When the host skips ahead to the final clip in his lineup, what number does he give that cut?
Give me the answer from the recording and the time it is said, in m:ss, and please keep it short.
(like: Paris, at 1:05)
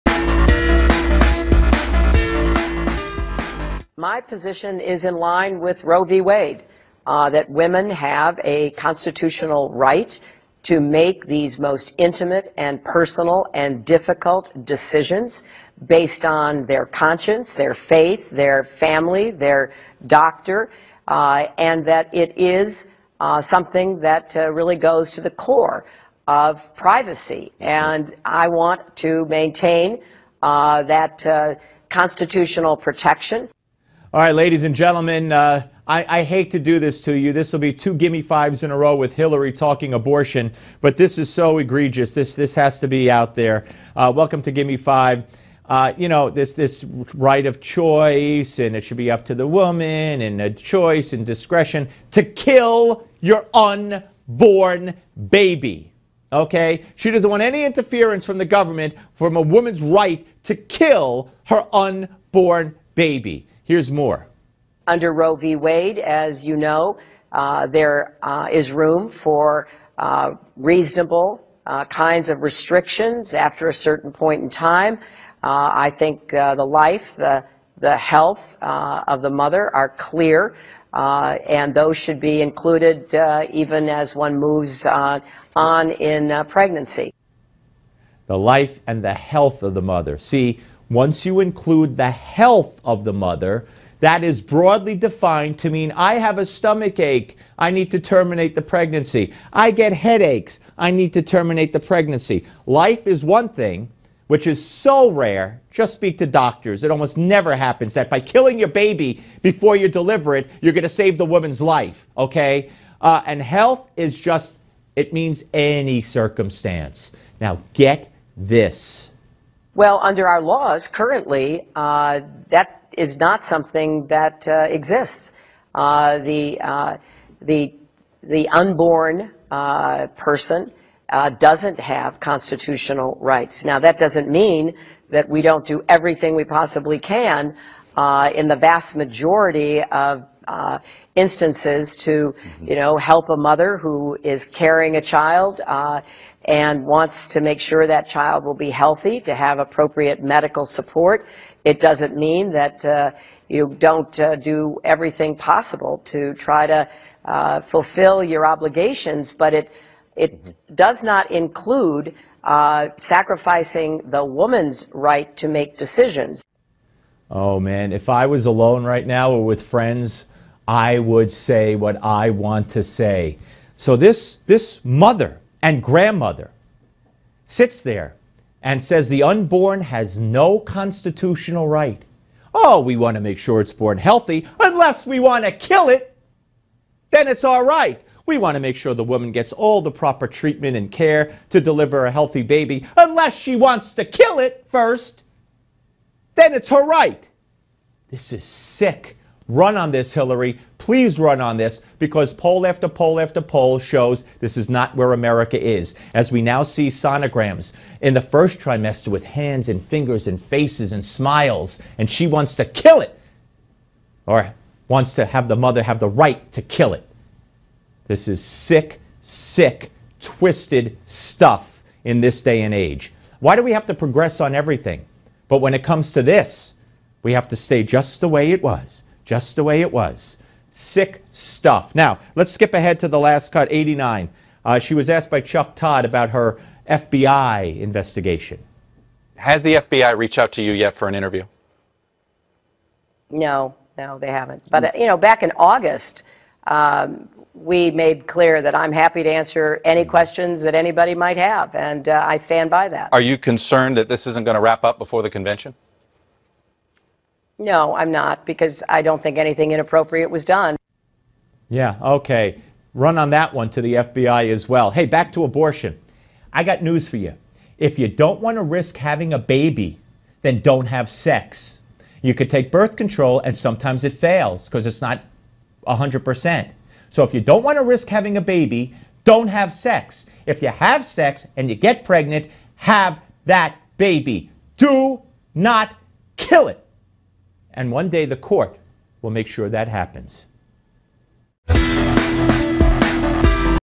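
89, at 3:53.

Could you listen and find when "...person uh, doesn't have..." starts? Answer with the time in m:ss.
2:10.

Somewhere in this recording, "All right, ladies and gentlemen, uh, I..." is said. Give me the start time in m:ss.
0:34.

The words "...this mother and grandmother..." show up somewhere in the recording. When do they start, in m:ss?
2:54.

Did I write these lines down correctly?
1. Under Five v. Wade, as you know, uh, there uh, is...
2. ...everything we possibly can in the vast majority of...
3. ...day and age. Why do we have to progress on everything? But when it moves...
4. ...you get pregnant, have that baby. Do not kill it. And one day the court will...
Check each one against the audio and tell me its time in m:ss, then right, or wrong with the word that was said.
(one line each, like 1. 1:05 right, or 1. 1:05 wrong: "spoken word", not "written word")
1. 1:04 wrong: "Roe", not "Five"
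2. 2:15 right
3. 3:42 wrong: "comes", not "moves"
4. 4:41 right.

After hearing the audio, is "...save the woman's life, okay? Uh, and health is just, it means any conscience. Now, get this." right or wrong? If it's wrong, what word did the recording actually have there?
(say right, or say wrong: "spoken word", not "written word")
wrong: "circumstance", not "conscience".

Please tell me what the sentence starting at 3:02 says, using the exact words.
Oh, we want to make sure it's born healthy, unless we want to kill it, then it's all right.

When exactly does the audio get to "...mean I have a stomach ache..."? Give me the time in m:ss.
1:35.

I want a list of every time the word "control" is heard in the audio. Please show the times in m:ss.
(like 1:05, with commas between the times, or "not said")
4:32.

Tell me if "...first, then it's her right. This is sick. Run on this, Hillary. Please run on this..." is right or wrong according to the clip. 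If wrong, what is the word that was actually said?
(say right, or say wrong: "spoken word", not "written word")
right.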